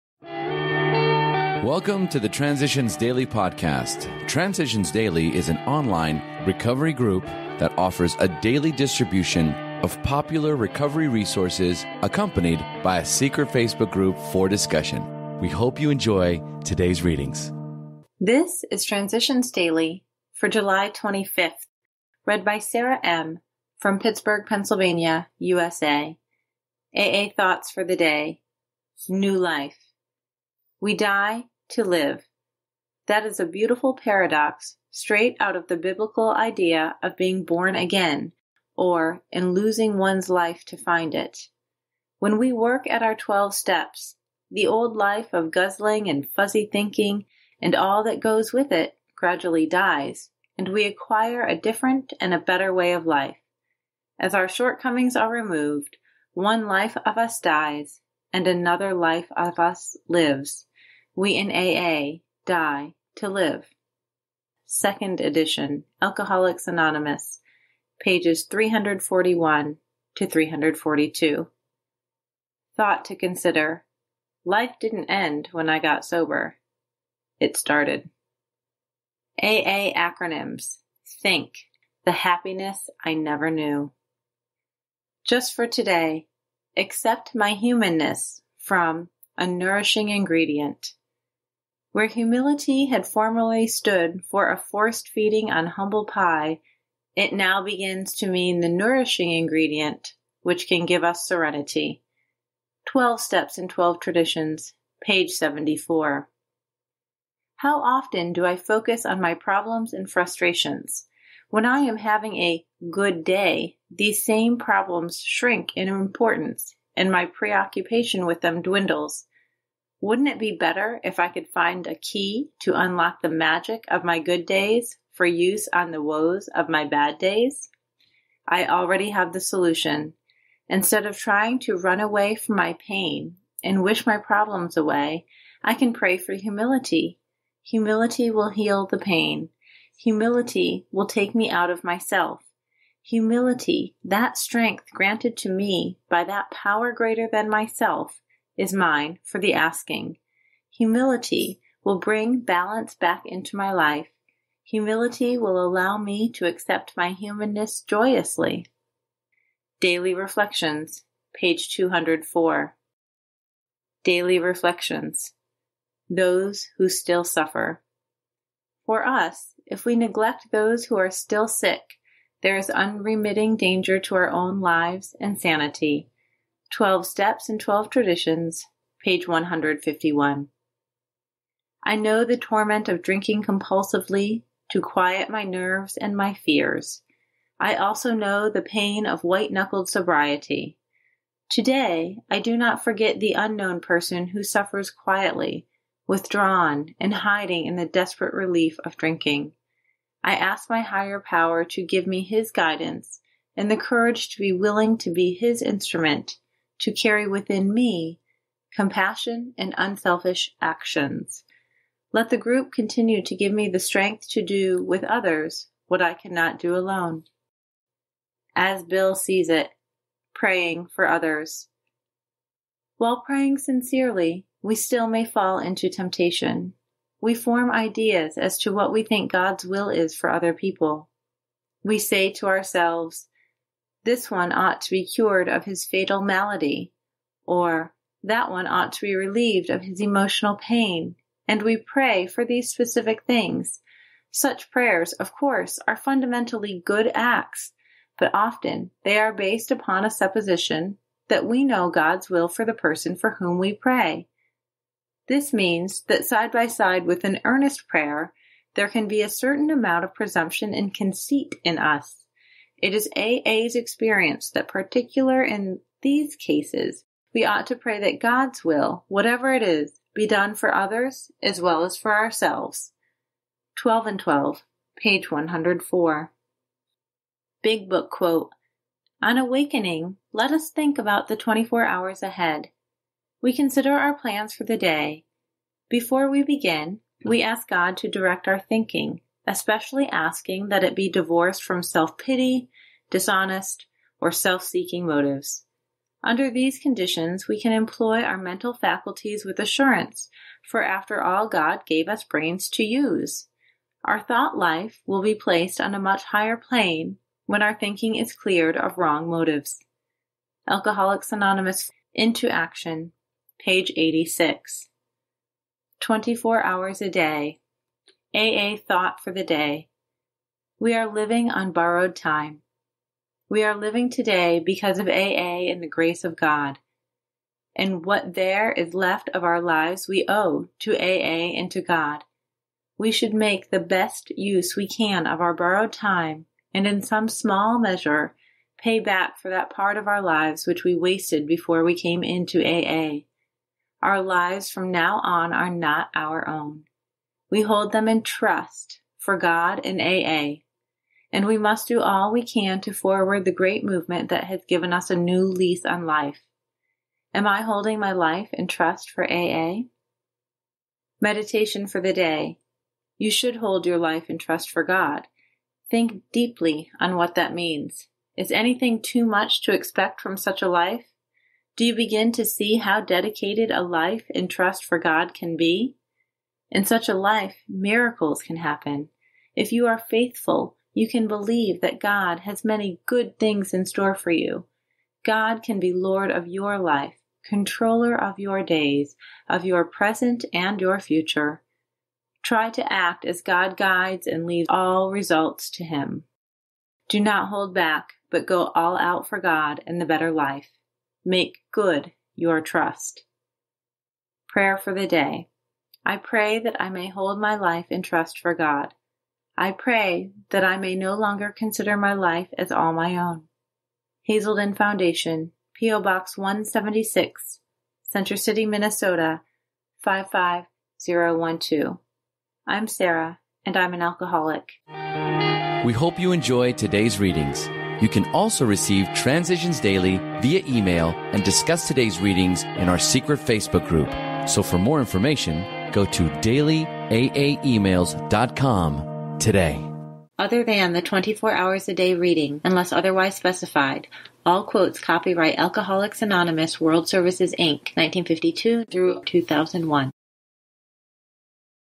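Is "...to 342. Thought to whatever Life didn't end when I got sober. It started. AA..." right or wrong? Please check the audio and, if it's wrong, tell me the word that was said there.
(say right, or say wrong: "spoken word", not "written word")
wrong: "consider", not "whatever".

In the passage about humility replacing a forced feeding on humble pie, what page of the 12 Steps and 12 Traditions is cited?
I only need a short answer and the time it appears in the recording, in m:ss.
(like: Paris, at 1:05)
74, at 1:45.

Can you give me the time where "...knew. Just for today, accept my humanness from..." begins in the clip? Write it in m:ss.
1:23.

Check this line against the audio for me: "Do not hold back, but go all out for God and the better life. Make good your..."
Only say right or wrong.
right.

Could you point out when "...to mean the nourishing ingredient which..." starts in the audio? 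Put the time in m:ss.
1:38.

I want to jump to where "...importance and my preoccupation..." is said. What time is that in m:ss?
1:55.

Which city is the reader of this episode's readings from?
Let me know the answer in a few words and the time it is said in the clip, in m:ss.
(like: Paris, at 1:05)
Pittsburgh, at 0:23.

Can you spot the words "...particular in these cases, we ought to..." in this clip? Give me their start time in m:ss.
4:24.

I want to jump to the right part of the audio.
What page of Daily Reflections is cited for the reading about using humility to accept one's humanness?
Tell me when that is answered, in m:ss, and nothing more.
2:41.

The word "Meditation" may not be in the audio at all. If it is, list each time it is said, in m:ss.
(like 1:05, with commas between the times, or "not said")
6:01.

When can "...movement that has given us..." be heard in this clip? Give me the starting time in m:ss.
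5:53.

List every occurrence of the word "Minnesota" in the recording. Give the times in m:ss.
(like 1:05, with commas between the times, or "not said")
6:58.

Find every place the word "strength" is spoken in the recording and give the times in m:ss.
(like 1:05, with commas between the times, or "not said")
2:24, 3:33.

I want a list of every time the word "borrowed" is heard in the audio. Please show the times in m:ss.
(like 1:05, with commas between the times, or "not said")
5:21, 5:35.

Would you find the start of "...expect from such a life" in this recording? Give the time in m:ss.
6:09.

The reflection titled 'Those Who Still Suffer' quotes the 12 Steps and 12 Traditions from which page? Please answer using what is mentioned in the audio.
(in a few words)
151.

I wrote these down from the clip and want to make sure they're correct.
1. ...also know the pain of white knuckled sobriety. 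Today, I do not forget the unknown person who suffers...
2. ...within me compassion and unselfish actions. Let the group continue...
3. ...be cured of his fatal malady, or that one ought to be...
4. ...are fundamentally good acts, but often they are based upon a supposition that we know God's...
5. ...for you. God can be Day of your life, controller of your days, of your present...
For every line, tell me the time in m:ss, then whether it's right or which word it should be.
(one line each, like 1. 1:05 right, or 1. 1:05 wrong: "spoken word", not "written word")
1. 3:07 right
2. 3:27 right
3. 3:54 right
4. 4:05 right
5. 6:24 wrong: "Lord", not "Day".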